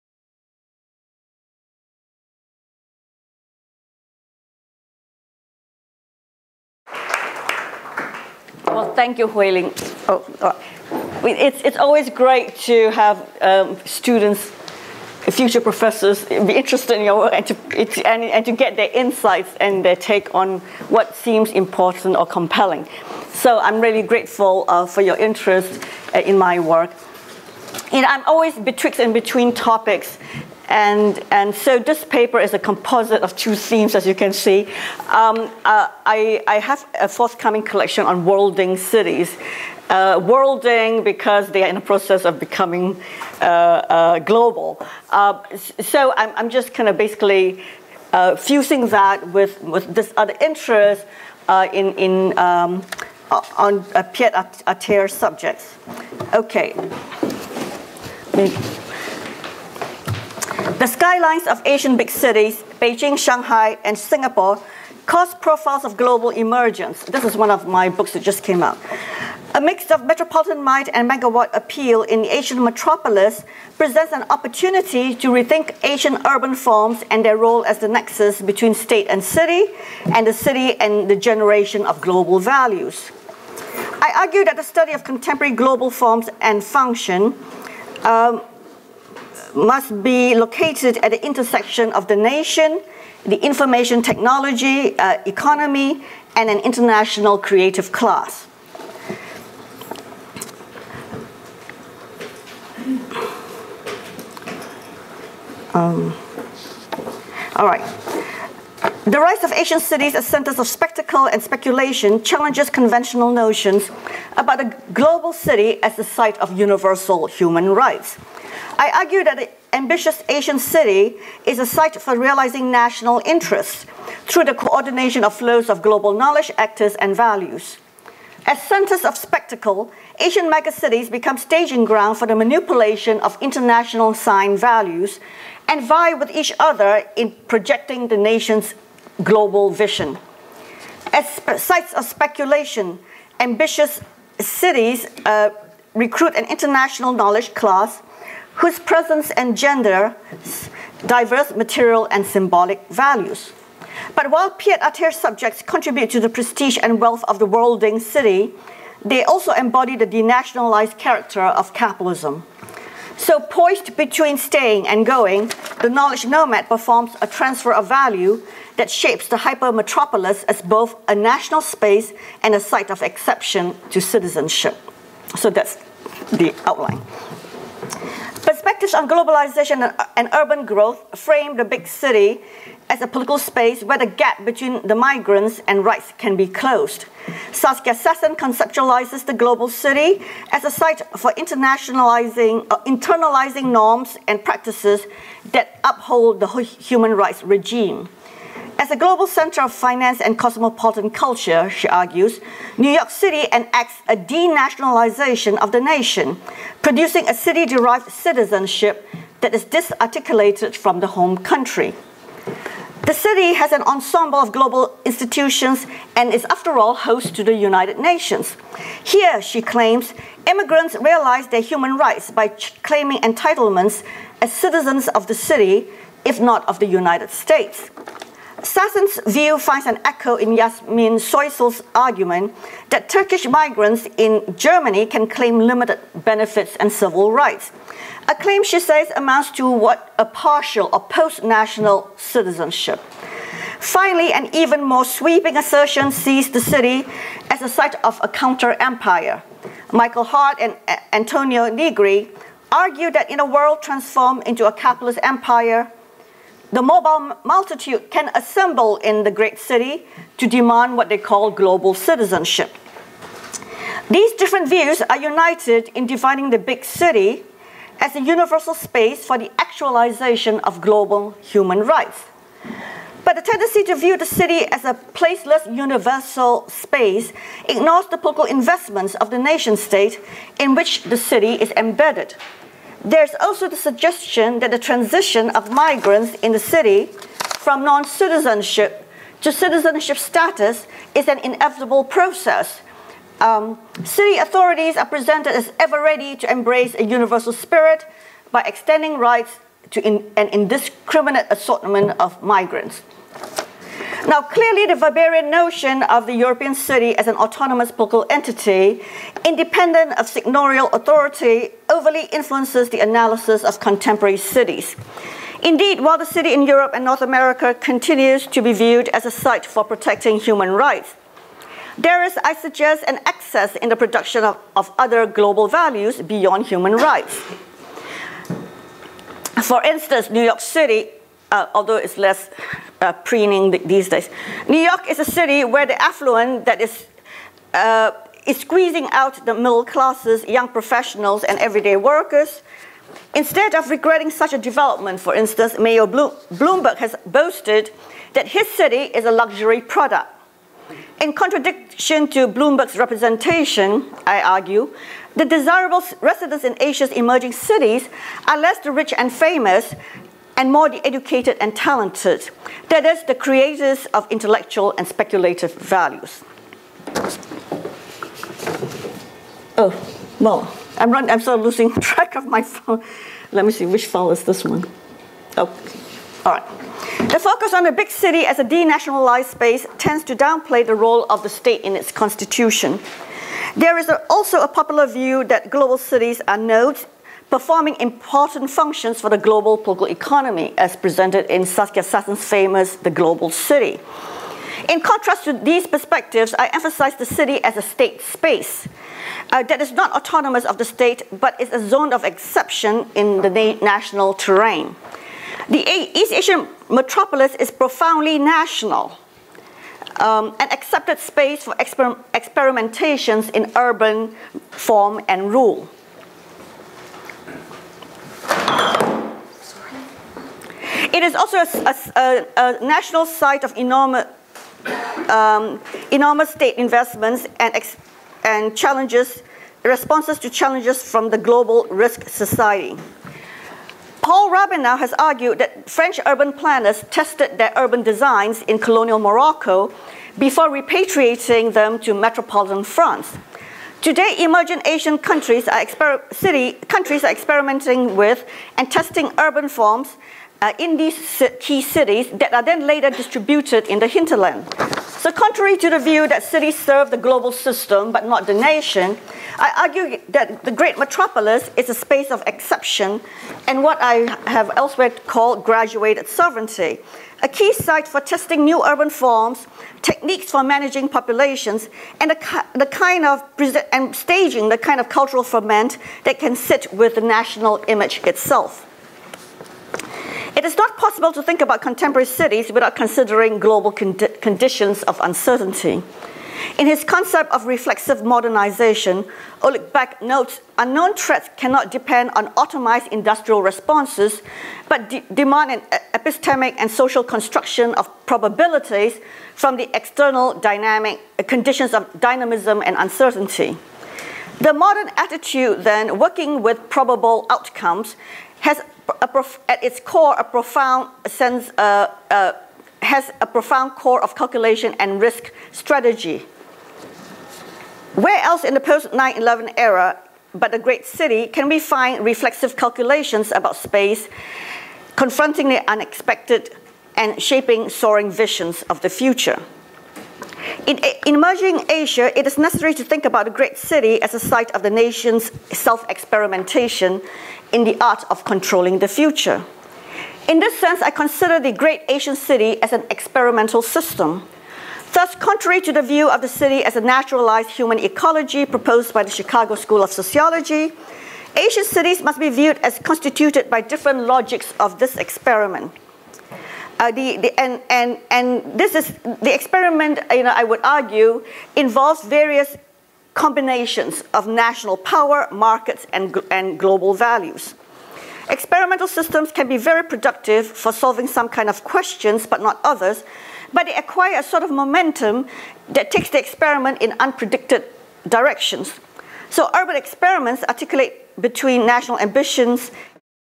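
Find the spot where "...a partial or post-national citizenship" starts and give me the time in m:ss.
4:00.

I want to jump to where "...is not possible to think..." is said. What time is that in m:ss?
8:00.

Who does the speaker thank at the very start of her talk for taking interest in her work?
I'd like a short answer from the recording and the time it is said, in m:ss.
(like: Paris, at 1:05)
Huiling, at 0:09.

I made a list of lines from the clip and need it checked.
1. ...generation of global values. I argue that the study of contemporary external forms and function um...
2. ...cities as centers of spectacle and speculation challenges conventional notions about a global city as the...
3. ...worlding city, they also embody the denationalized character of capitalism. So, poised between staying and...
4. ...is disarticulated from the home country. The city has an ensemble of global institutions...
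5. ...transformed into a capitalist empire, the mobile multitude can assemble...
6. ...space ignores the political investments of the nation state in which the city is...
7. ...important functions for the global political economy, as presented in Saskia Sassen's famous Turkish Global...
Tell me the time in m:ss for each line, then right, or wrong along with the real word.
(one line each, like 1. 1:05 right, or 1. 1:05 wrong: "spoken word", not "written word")
1. 1:21 wrong: "global", not "external"
2. 1:49 right
3. 2:37 right
4. 3:29 right
5. 4:13 right
6. 4:36 right
7. 6:27 wrong: "The", not "Turkish".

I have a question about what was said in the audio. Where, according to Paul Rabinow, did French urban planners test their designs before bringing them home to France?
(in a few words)
colonial Morocco.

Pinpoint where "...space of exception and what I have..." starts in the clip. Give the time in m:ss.
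7:41.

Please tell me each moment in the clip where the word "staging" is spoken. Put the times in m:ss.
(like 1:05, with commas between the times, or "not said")
2:11, 7:54.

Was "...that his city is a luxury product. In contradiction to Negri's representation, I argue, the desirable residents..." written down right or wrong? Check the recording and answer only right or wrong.
wrong.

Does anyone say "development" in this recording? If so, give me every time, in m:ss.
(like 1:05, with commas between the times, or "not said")
5:44.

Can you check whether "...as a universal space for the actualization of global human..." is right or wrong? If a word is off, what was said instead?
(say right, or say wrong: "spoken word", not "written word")
right.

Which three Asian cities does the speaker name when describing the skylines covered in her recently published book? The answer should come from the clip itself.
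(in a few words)
Beijing, Shanghai, and Singapore.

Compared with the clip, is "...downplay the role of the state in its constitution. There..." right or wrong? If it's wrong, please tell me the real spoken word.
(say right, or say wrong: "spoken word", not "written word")
right.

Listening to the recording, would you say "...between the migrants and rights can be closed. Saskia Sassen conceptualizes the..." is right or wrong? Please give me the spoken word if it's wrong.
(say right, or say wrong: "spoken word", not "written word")
right.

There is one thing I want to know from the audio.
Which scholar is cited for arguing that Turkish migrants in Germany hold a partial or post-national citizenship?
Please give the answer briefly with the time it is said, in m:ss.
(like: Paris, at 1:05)
Yasmin Soysal, at 3:50.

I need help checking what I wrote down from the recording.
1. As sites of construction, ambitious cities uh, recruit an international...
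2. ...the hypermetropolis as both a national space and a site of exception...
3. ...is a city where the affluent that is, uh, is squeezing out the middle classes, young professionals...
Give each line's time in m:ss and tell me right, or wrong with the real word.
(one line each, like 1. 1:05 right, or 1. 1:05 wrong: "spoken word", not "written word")
1. 2:21 wrong: "speculation", not "construction"
2. 2:49 right
3. 5:35 right.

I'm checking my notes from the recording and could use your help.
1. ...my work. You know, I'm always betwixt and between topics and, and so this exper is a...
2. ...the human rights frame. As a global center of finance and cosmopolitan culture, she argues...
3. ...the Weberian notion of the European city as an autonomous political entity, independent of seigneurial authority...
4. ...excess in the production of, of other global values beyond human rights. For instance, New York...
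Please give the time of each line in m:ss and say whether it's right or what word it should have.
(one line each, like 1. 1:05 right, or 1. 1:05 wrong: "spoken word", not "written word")
1. 0:26 wrong: "paper", not "exper"
2. 3:16 wrong: "regime", not "frame"
3. 5:04 right
4. 5:23 right.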